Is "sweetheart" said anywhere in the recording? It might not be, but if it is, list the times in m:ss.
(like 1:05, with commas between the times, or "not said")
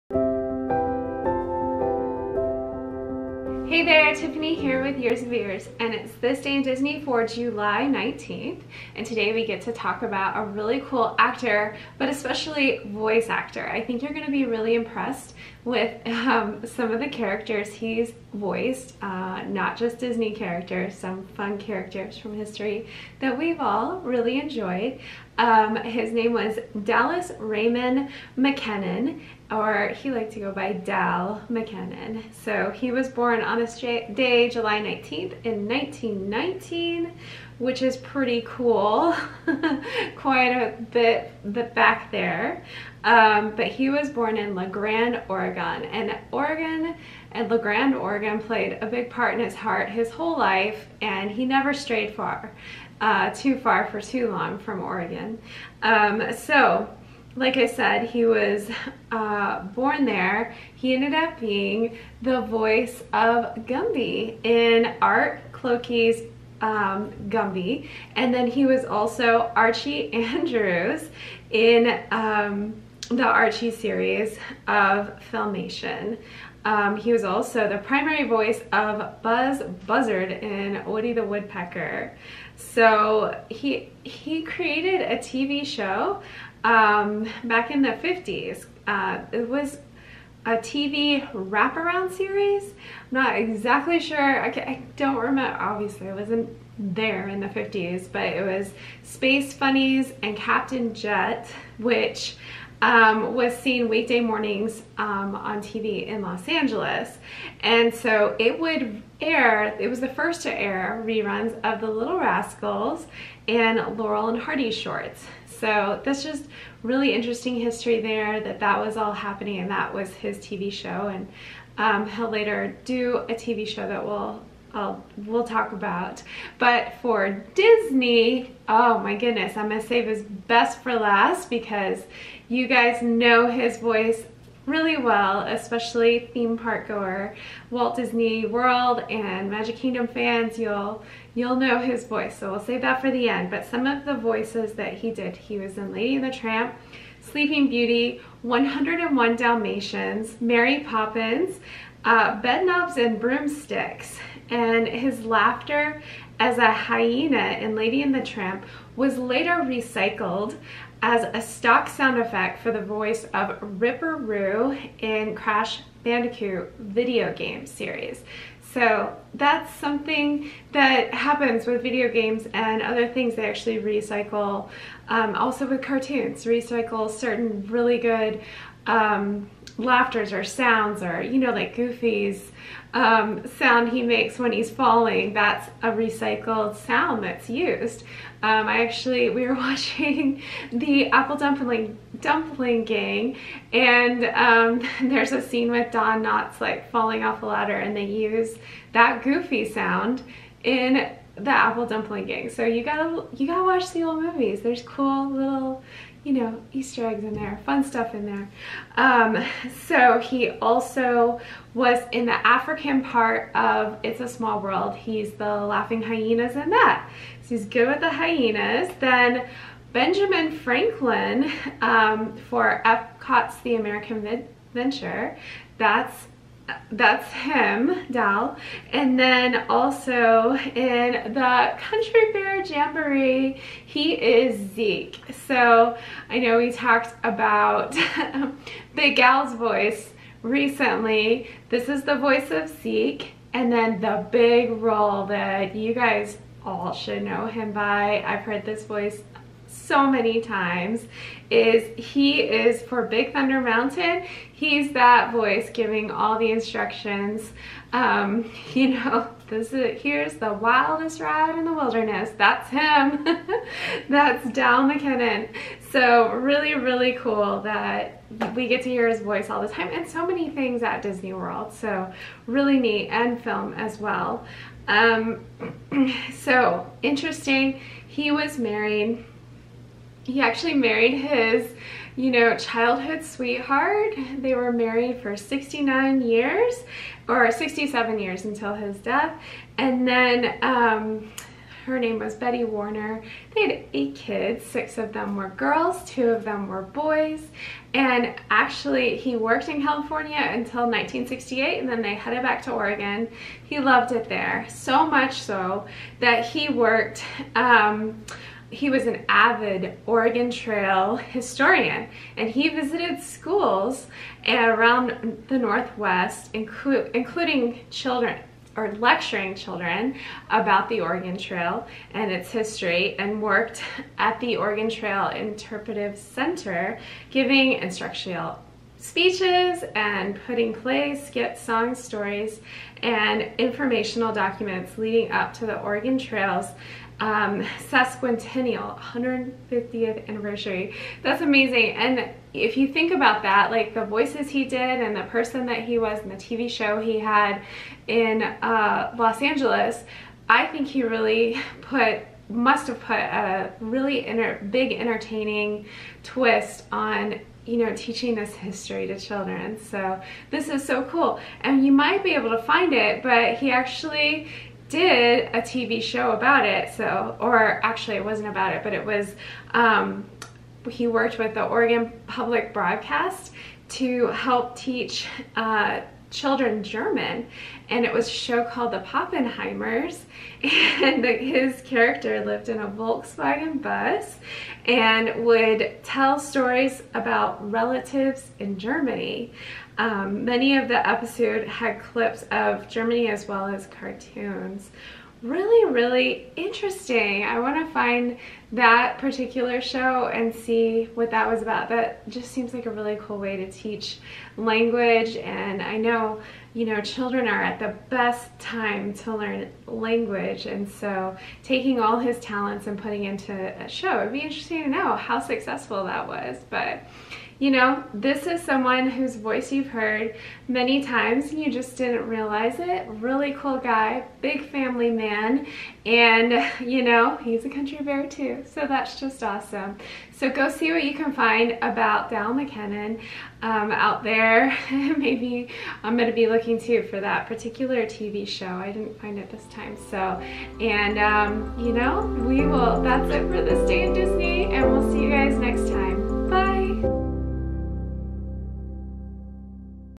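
4:43.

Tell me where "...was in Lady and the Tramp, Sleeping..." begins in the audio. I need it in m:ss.
2:25.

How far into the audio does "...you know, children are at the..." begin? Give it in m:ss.
6:46.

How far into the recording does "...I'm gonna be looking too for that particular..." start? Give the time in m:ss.
7:16.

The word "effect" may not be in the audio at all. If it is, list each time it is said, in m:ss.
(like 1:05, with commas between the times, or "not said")
2:42.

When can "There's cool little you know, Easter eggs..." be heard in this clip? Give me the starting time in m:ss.
3:24.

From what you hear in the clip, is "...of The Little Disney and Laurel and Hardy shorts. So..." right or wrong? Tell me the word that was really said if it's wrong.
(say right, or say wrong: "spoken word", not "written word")
wrong: "Rascals", not "Disney".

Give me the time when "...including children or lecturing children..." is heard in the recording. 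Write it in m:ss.
5:17.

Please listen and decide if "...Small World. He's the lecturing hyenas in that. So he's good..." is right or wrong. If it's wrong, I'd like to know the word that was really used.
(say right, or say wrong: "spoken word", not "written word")
wrong: "laughing", not "lecturing".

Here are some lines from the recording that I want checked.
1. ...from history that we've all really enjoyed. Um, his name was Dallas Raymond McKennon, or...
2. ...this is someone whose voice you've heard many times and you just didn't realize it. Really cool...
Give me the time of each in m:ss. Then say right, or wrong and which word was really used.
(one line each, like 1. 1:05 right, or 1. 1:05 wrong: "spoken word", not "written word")
1. 0:22 right
2. 6:58 right.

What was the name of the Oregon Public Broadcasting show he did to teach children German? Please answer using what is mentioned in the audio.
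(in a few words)
The Poppenheimers.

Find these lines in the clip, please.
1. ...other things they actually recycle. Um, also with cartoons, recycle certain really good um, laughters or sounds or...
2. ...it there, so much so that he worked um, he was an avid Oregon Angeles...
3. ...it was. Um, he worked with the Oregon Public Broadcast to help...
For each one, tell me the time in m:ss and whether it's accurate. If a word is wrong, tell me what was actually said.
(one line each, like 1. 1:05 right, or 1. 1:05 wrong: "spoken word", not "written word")
1. 2:52 right
2. 5:04 wrong: "Trail", not "Angeles"
3. 6:08 right.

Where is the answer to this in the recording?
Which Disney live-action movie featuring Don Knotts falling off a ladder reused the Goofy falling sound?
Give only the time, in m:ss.
3:21.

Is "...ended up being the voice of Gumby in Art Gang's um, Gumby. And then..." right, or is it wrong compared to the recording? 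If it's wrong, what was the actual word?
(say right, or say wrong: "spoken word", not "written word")
wrong: "Clokey", not "Gang".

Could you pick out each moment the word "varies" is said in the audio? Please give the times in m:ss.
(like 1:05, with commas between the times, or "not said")
not said.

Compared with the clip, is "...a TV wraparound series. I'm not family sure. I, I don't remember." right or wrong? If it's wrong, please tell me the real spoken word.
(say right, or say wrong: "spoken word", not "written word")
wrong: "exactly", not "family".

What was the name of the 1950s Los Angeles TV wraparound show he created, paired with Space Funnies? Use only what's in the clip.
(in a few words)
Captain Jet.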